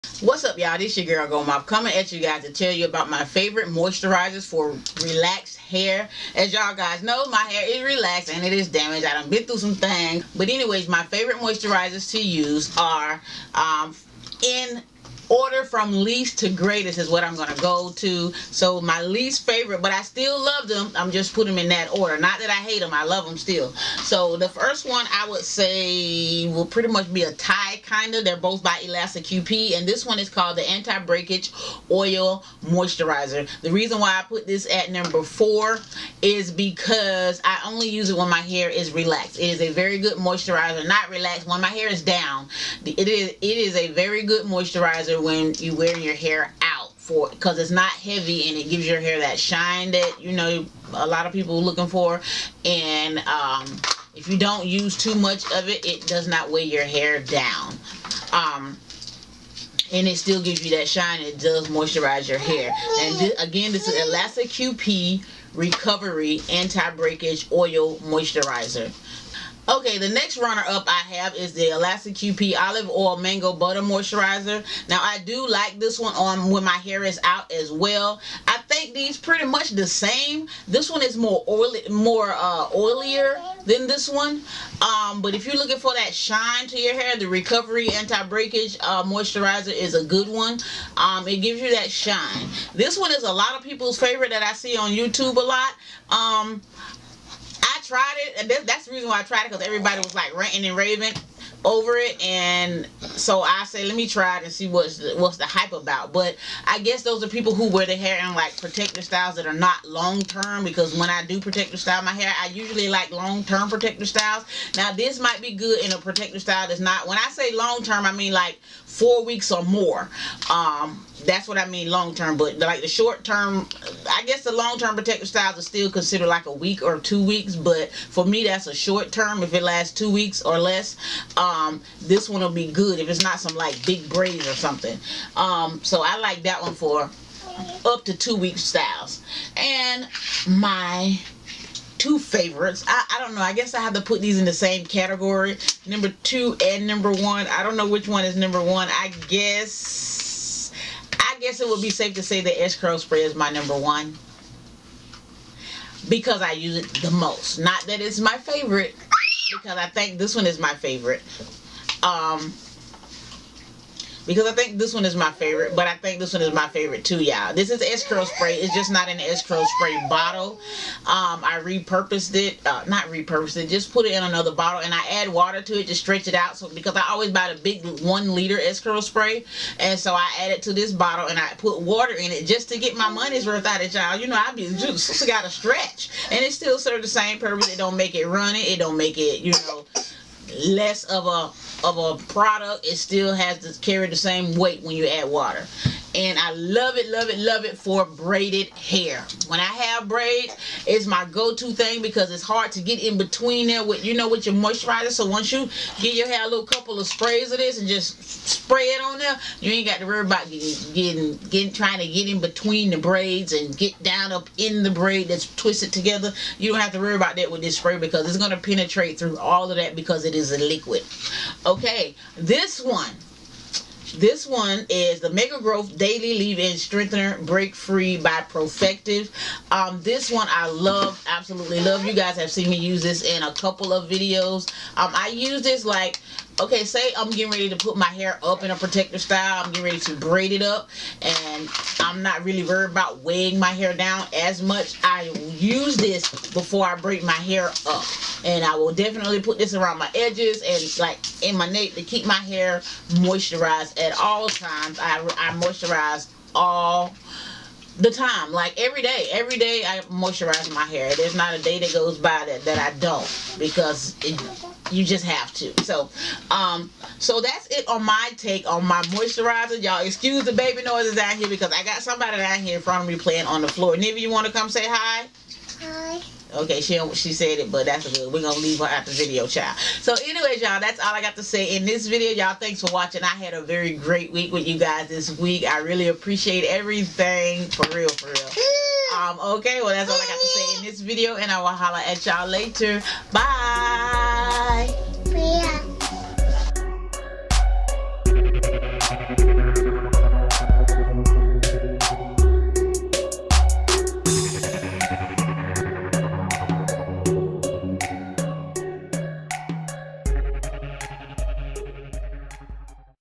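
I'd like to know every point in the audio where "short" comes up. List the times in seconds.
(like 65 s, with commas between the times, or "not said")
122 s, 128 s.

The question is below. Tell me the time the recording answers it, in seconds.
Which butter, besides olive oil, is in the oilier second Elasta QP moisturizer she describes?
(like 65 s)
73 s.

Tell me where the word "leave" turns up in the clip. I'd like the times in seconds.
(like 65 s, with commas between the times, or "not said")
226 s, 278 s.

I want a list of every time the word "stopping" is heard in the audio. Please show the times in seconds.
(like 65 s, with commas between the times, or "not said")
not said.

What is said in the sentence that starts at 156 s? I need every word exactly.
Because I use it the most.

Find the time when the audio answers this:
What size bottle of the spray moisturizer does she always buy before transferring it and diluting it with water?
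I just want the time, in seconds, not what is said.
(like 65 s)
178 s.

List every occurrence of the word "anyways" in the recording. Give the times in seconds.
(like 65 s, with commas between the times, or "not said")
10 s, 280 s.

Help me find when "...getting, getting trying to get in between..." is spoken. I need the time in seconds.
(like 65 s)
210 s.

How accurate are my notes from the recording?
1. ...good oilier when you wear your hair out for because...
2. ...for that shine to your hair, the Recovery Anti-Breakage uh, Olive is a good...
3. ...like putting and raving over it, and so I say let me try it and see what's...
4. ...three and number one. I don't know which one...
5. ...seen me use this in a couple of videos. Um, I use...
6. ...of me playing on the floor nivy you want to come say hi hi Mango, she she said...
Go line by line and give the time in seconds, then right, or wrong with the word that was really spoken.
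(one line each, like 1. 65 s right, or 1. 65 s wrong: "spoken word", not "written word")
1. 44 s wrong: "moisturizer", not "oilier"
2. 85 s wrong: "Moisturizer", not "Olive"
3. 100 s wrong: "ranting", not "putting"
4. 146 s wrong: "two", not "three"
5. 232 s right
6. 273 s wrong: "Okay", not "Mango".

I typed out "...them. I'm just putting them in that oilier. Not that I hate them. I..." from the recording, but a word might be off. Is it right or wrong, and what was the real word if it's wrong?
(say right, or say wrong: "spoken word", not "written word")
wrong: "order", not "oilier".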